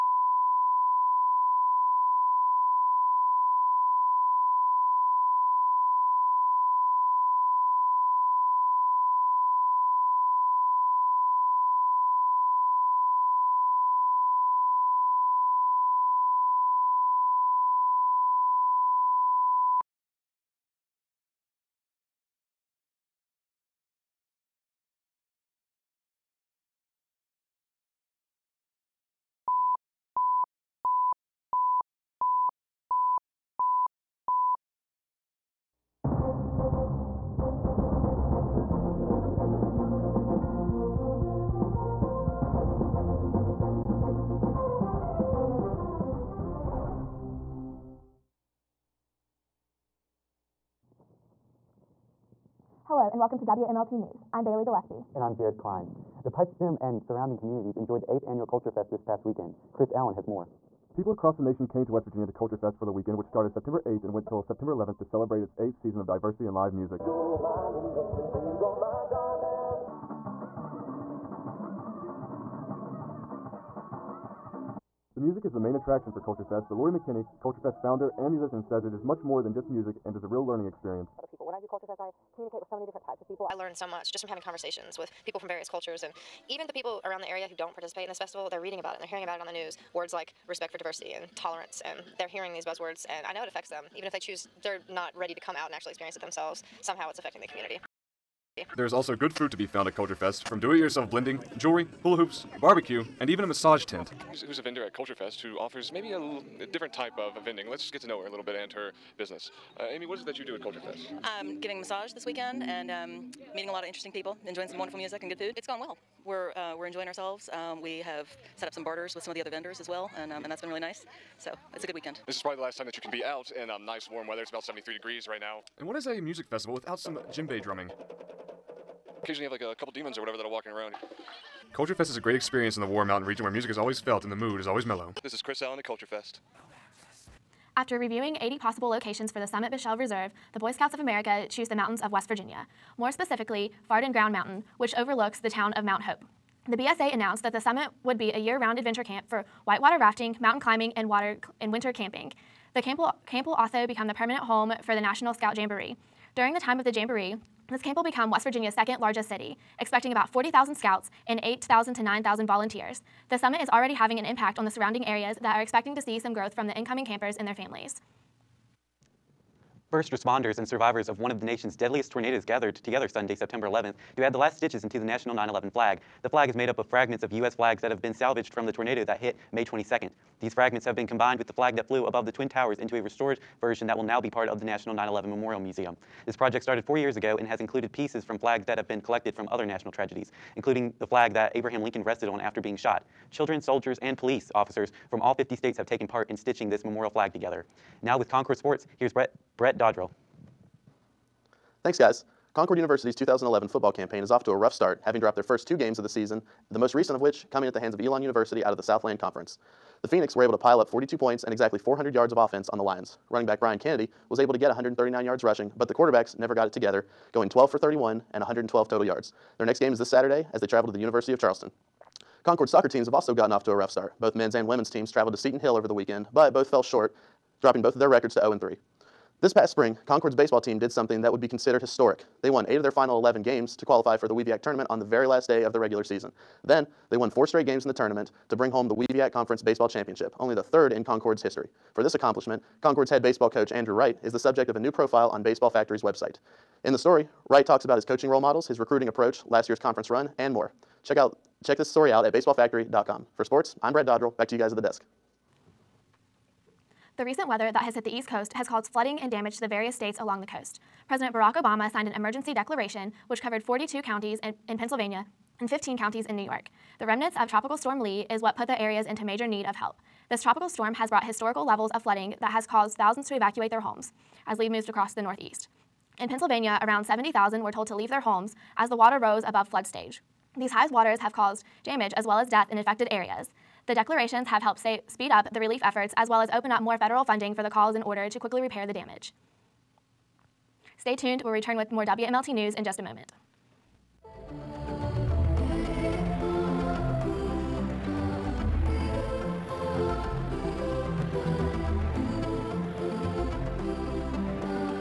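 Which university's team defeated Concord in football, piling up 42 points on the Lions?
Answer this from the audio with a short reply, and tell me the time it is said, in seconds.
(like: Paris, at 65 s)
Elon University, at 207 s.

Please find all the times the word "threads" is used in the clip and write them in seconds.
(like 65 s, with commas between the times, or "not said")
not said.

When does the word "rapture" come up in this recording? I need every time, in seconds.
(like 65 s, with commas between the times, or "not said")
not said.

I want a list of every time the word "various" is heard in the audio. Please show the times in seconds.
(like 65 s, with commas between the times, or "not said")
85 s, 259 s.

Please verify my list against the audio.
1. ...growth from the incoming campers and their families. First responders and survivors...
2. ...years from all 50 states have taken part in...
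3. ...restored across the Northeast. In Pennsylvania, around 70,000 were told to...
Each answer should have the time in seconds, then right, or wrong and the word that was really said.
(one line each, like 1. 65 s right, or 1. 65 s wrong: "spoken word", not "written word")
1. 166 s right
2. 194 s wrong: "officers", not "years"
3. 274 s wrong: "moved", not "restored".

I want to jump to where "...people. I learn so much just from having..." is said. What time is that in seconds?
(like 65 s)
83 s.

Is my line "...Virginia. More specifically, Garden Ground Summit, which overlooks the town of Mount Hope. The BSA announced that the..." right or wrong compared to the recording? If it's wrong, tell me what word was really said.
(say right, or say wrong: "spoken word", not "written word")
wrong: "Mountain", not "Summit".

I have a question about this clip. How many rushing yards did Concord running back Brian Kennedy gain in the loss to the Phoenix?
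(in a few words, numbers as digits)
139.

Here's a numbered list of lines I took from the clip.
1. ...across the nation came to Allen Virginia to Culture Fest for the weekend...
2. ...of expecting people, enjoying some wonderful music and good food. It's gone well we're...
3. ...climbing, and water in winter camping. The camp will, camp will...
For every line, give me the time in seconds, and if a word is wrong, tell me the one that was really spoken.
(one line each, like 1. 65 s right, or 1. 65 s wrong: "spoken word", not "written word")
1. 61 s wrong: "West", not "Allen"
2. 113 s wrong: "interesting", not "expecting"
3. 150 s right.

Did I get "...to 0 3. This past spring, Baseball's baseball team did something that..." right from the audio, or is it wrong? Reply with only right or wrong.
wrong.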